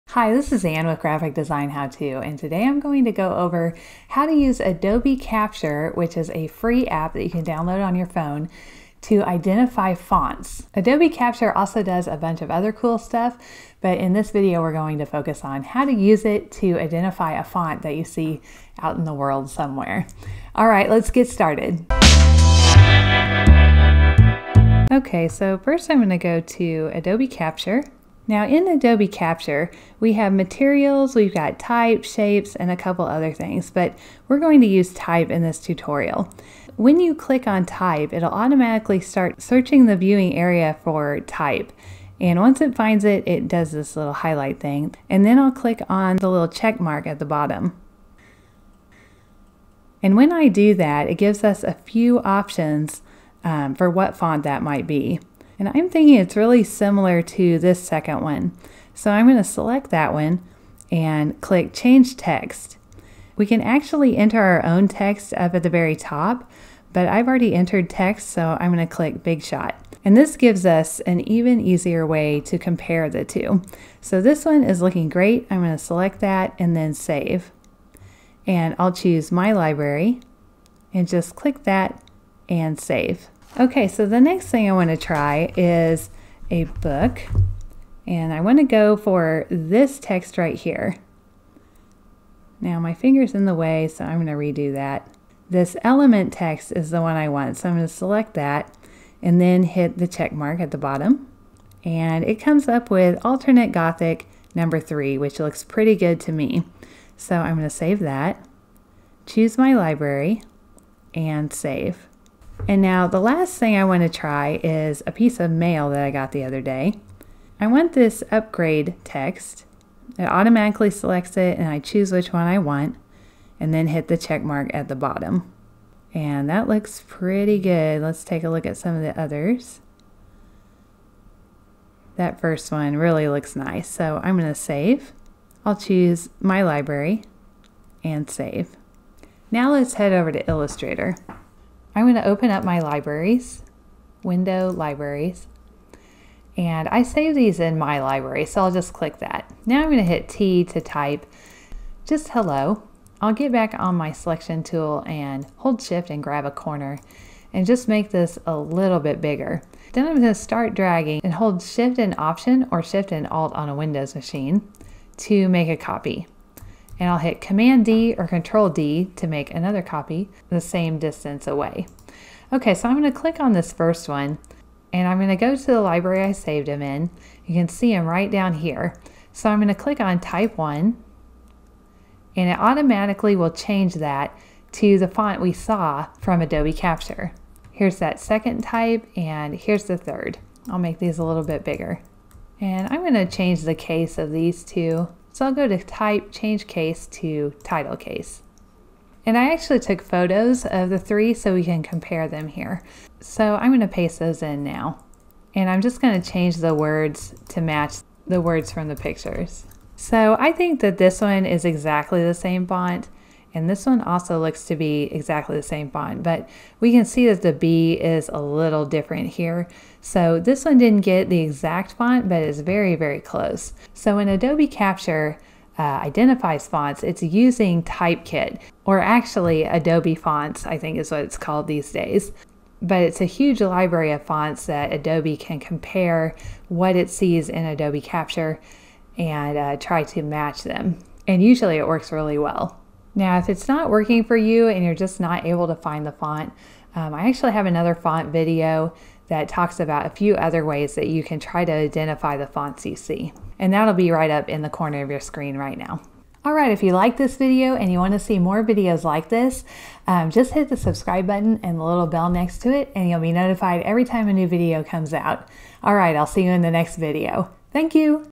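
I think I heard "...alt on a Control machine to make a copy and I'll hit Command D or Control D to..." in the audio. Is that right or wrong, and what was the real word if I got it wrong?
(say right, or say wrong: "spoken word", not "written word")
wrong: "Windows", not "Control".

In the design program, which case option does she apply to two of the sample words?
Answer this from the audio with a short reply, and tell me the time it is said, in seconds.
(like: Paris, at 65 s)
title case, at 197 s.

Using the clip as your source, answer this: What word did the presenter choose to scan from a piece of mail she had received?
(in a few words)
upgrade.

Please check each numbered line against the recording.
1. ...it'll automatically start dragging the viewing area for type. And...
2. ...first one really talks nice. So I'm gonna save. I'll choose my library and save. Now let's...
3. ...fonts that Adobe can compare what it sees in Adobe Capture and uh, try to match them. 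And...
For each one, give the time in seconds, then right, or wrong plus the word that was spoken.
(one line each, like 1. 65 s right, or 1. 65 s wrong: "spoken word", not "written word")
1. 38 s wrong: "searching", not "dragging"
2. 132 s wrong: "looks", not "talks"
3. 234 s right.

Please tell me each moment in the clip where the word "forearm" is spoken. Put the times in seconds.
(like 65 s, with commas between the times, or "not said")
not said.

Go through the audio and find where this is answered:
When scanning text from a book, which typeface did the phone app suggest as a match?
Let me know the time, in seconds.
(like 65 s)
103 s.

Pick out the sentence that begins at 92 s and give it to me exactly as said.
Now my finger's in the way, so I'm going to redo that.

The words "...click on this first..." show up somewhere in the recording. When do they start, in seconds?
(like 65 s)
173 s.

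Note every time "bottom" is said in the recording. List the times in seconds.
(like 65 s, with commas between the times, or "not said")
47 s, 100 s, 124 s.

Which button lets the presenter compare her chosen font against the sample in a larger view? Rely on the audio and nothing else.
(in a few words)
Big Shot.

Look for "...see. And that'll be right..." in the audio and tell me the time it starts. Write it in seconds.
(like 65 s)
252 s.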